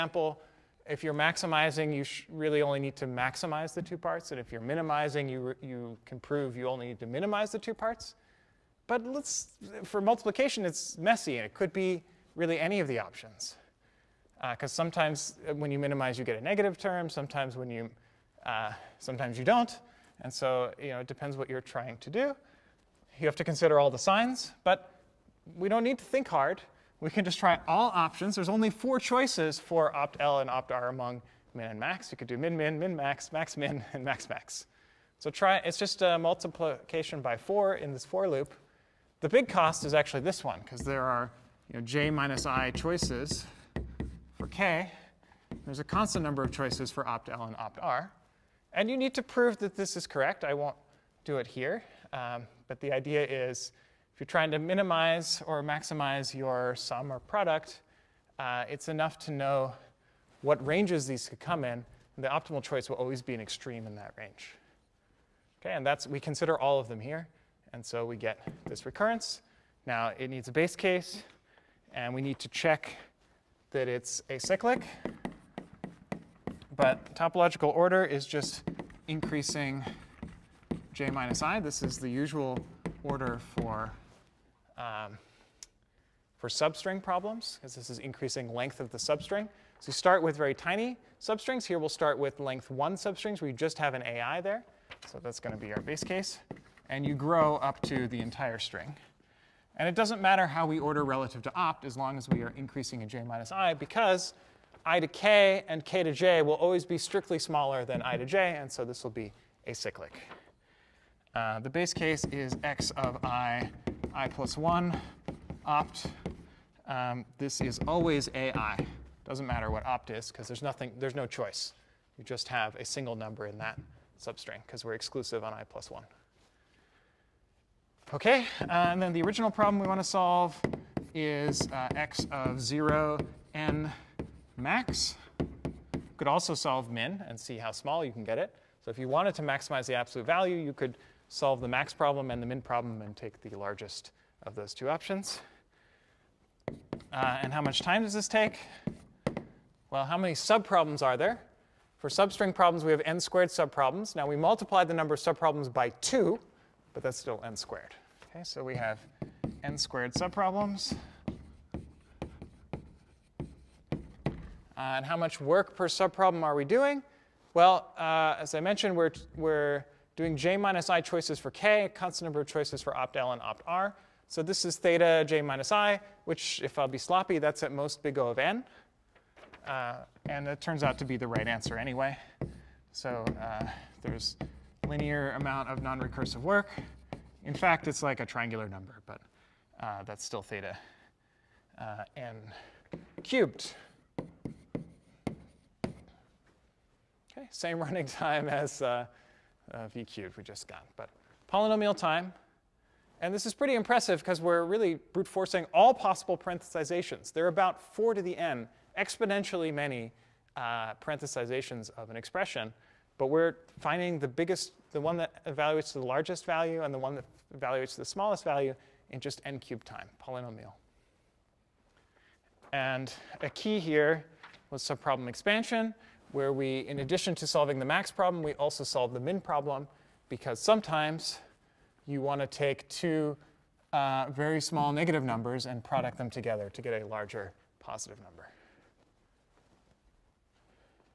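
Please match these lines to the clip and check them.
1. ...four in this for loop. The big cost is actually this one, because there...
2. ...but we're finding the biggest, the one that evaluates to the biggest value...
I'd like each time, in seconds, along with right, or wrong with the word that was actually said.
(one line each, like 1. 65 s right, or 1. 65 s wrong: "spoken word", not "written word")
1. 37 s right
2. 213 s wrong: "largest", not "biggest".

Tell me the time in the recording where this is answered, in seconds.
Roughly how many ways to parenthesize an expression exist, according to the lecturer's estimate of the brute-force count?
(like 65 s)
207 s.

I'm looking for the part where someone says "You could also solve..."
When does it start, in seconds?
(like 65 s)
135 s.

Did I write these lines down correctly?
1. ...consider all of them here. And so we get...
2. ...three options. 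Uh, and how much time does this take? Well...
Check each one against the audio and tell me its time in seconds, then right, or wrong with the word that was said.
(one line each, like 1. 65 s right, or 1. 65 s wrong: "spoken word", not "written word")
1. 66 s right
2. 144 s wrong: "two", not "three".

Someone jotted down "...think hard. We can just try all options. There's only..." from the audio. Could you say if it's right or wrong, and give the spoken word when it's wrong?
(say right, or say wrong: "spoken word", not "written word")
right.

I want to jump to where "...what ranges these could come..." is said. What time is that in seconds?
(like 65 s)
60 s.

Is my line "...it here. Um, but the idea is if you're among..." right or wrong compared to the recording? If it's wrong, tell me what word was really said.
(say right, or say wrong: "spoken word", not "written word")
wrong: "trying", not "among".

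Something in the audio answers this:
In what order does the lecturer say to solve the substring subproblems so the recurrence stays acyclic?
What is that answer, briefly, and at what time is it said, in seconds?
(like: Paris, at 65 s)
Increasing j minus i, at 79 s.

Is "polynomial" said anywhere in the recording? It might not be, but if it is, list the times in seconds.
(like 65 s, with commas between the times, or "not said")
201 s, 220 s.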